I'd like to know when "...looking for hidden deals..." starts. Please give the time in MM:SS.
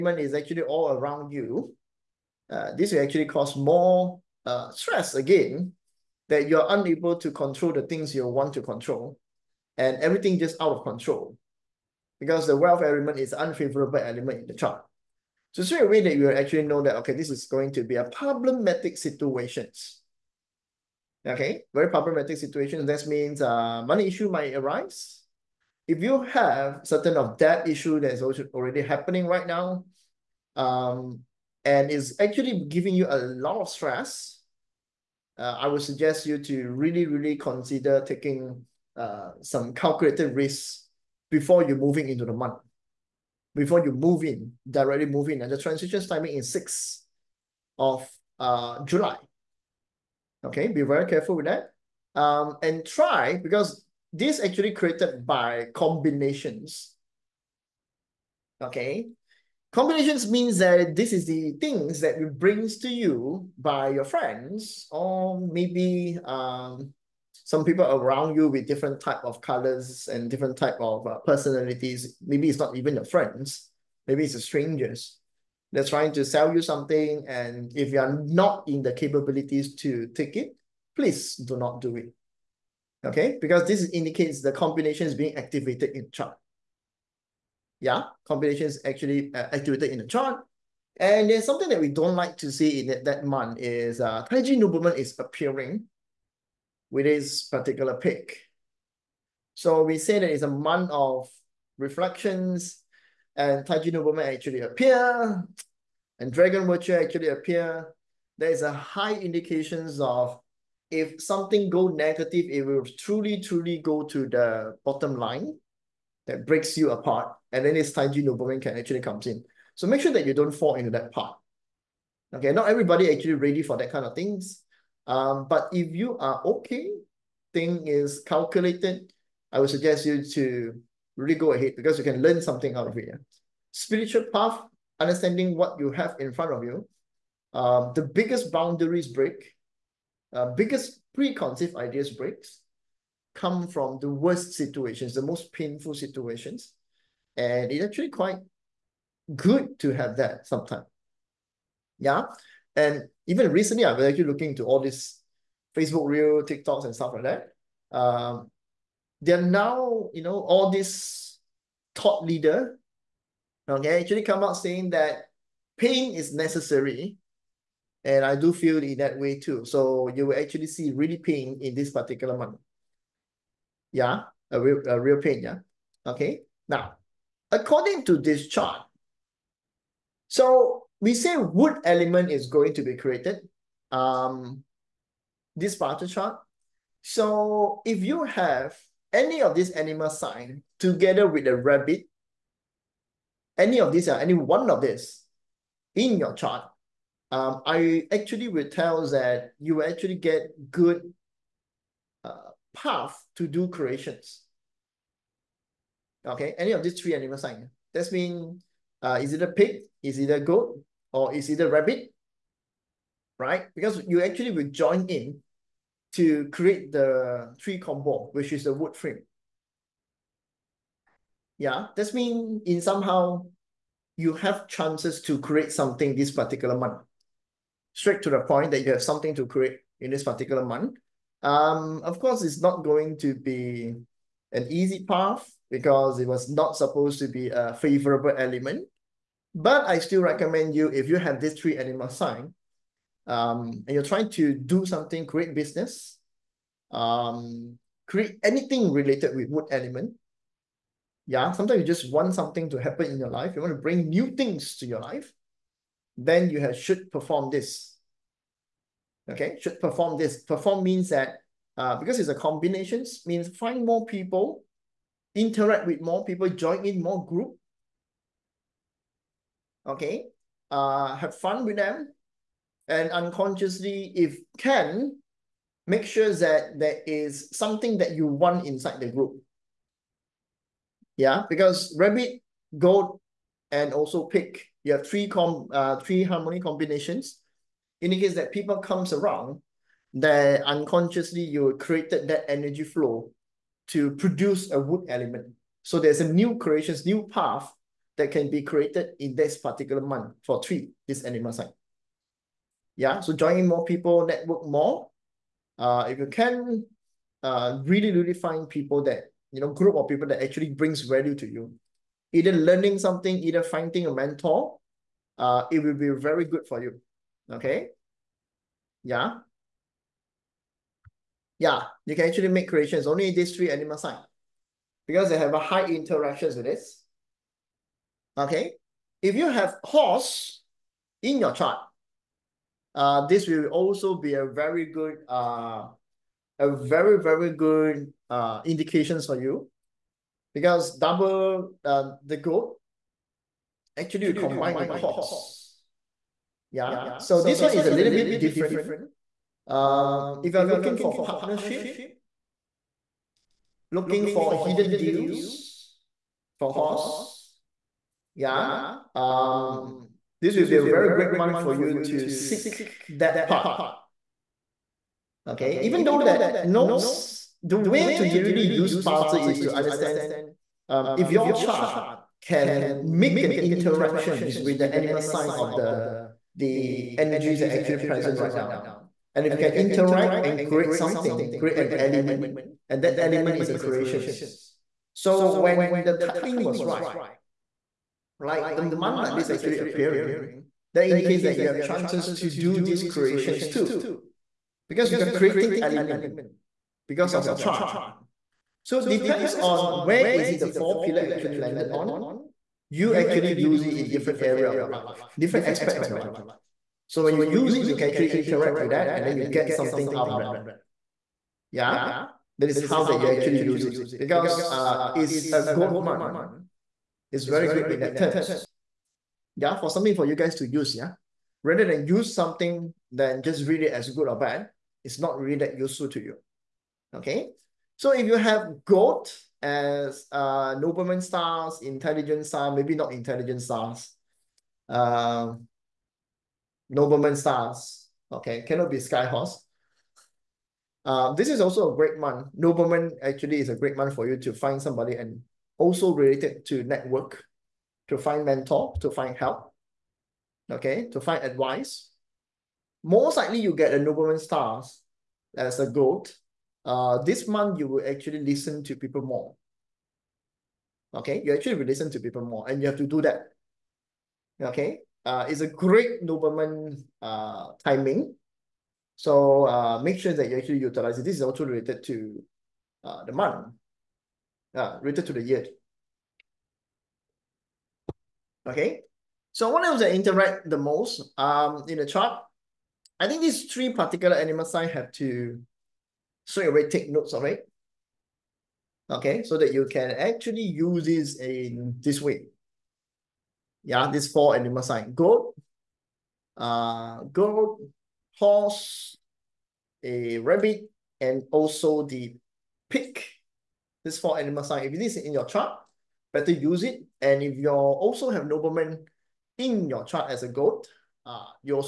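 05:53.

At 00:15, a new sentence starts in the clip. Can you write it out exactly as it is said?
So straight away that you actually know that, okay, this is going to be a problematic situations.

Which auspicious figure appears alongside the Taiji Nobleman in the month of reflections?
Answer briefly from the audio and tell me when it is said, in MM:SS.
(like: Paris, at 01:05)
Dragon Virtue, at 01:46.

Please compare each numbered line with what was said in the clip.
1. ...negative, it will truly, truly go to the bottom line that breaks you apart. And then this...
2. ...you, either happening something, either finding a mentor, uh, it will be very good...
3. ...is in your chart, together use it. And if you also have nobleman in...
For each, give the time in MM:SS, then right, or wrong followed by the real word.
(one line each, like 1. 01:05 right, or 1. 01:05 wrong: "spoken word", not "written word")
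1. 01:51 right
2. 05:11 wrong: "learning", not "happening"
3. 08:25 wrong: "better", not "together".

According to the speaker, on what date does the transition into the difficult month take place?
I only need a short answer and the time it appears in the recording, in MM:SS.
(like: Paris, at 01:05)
6 July, at 00:46.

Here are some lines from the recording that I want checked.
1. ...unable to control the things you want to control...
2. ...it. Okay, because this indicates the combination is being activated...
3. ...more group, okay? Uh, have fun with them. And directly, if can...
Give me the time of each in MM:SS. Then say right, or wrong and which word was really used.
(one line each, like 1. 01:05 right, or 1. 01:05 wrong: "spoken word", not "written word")
1. 00:06 right
2. 01:21 right
3. 04:27 wrong: "unconsciously", not "directly".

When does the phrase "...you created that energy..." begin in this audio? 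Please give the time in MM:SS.
04:51.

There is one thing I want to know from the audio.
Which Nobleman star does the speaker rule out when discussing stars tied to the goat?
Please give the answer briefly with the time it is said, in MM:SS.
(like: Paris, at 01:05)
Sky Horse, at 07:18.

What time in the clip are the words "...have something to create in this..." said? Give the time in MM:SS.
03:48.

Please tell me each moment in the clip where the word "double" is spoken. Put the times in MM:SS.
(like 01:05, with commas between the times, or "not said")
05:40.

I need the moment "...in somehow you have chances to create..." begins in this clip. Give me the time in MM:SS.
03:42.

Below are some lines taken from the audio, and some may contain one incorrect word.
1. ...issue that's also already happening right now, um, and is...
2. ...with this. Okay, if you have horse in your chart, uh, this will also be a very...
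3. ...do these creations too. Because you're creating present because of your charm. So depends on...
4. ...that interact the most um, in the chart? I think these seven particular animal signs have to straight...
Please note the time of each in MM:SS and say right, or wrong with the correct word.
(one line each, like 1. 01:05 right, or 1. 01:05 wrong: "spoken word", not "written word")
1. 00:27 right
2. 05:26 right
3. 06:32 wrong: "element", not "present"
4. 07:59 wrong: "three", not "seven".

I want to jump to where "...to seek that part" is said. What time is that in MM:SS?
06:02.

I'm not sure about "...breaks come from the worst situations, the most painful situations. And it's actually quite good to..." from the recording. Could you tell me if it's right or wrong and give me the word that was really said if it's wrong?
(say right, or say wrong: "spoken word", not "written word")
right.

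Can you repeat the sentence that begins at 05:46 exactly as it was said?
Yeah, so this one is a little bit different.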